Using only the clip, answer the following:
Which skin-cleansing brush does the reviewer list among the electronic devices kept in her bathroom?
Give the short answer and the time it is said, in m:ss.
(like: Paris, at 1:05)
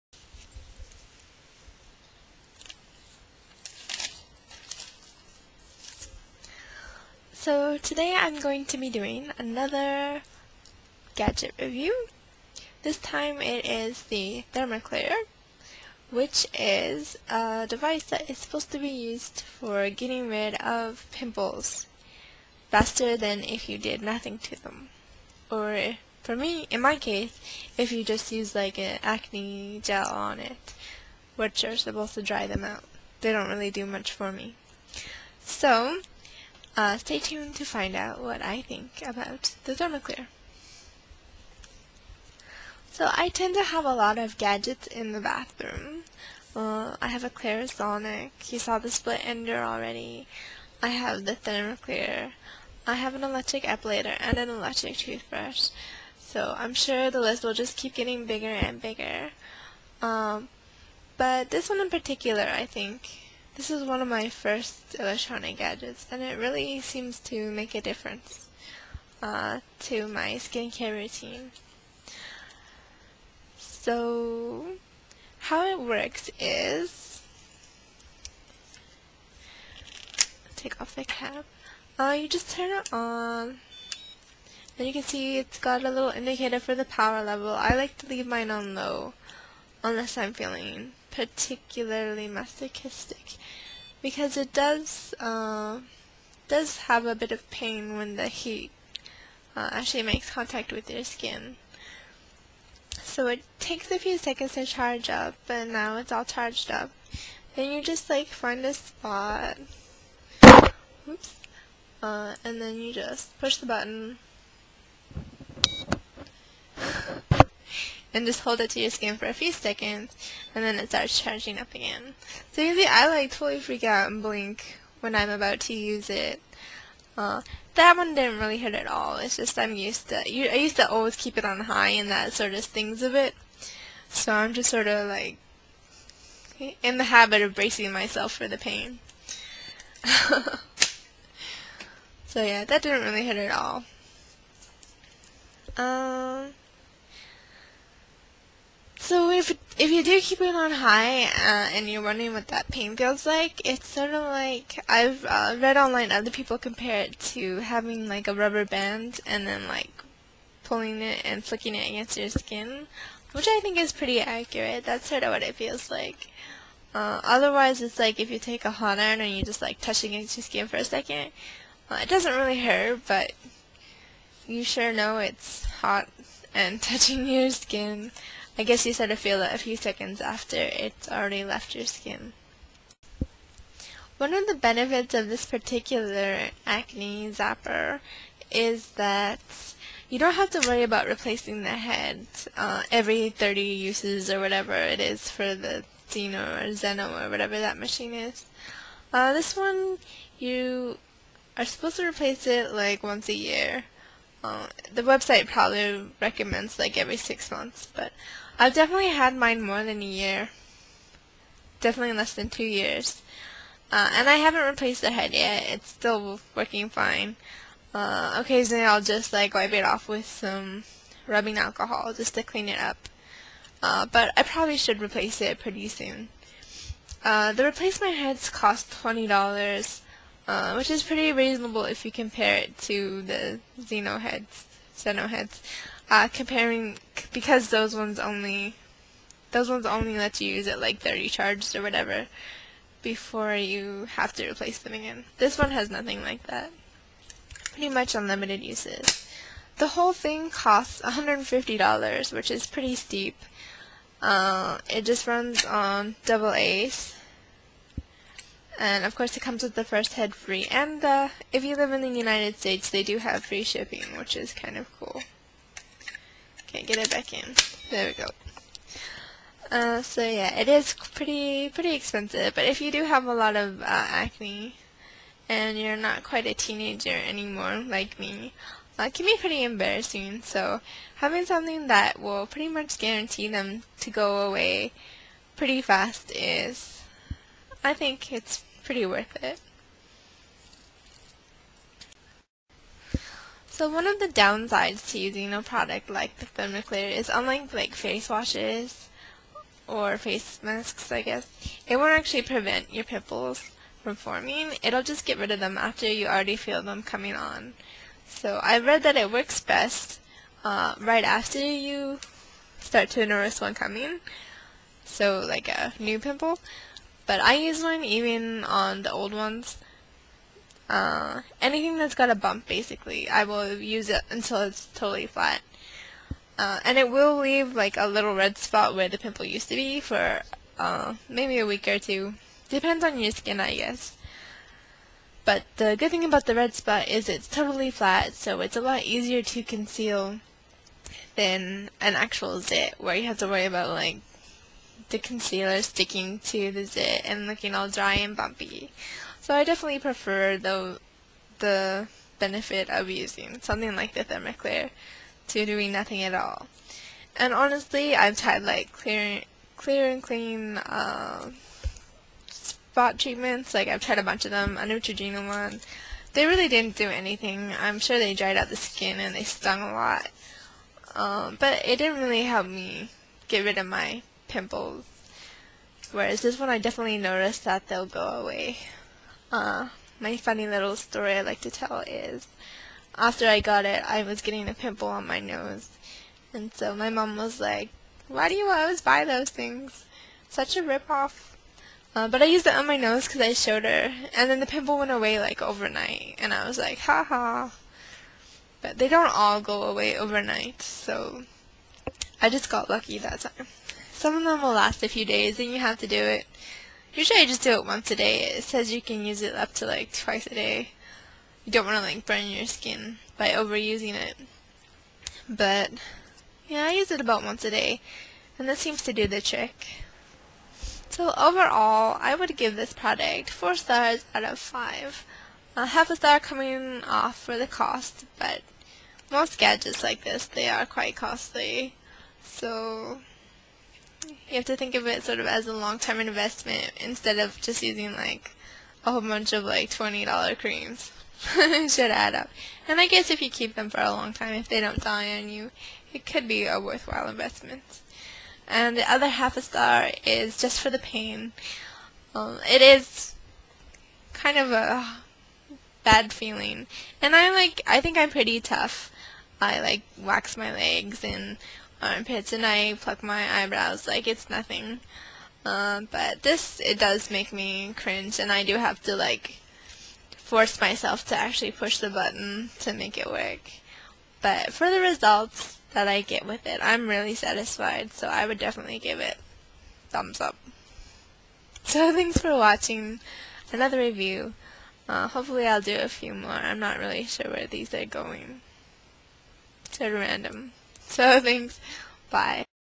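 Clarisonic, at 0:47.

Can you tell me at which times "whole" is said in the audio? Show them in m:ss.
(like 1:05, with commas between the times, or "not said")
4:09, 7:19.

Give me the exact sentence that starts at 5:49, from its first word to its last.
So I definitely prefer the, the benefit of using something like the Thermaclear to doing nothing at all.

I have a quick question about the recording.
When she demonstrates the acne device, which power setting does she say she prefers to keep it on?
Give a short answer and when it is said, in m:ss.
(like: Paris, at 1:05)
low, at 1:28.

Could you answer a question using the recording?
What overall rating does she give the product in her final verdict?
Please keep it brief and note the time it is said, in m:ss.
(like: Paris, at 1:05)
4 stars out of 5, at 7:03.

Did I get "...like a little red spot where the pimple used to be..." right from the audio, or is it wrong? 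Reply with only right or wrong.
right.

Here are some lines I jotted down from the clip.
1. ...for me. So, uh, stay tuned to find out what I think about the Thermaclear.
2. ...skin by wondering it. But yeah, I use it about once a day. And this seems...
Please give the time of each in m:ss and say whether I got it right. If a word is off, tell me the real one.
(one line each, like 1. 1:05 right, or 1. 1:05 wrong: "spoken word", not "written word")
1. 0:34 right
2. 6:52 wrong: "overusing", not "wondering".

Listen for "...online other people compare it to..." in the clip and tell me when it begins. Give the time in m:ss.
2:35.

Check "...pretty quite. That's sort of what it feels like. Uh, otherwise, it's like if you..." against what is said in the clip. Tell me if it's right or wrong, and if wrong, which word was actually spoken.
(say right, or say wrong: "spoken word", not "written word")
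wrong: "accurate", not "quite".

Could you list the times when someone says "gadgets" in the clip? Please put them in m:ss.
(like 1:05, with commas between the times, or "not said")
0:11, 0:44, 1:05, 7:09.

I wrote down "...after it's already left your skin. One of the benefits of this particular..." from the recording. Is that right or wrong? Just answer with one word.
right.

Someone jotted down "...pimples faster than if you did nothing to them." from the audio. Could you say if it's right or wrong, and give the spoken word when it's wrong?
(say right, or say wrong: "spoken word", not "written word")
right.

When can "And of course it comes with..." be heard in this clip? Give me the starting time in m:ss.
4:18.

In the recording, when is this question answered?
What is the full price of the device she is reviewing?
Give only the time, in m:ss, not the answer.
4:11.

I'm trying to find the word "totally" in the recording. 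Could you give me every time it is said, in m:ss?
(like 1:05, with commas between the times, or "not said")
2:03, 5:24, 5:37.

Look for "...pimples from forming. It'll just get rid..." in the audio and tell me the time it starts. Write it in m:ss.
5:03.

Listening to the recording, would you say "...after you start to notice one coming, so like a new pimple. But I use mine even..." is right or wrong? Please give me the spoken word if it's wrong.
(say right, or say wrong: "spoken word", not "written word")
right.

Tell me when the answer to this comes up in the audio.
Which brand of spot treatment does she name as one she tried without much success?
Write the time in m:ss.
6:04.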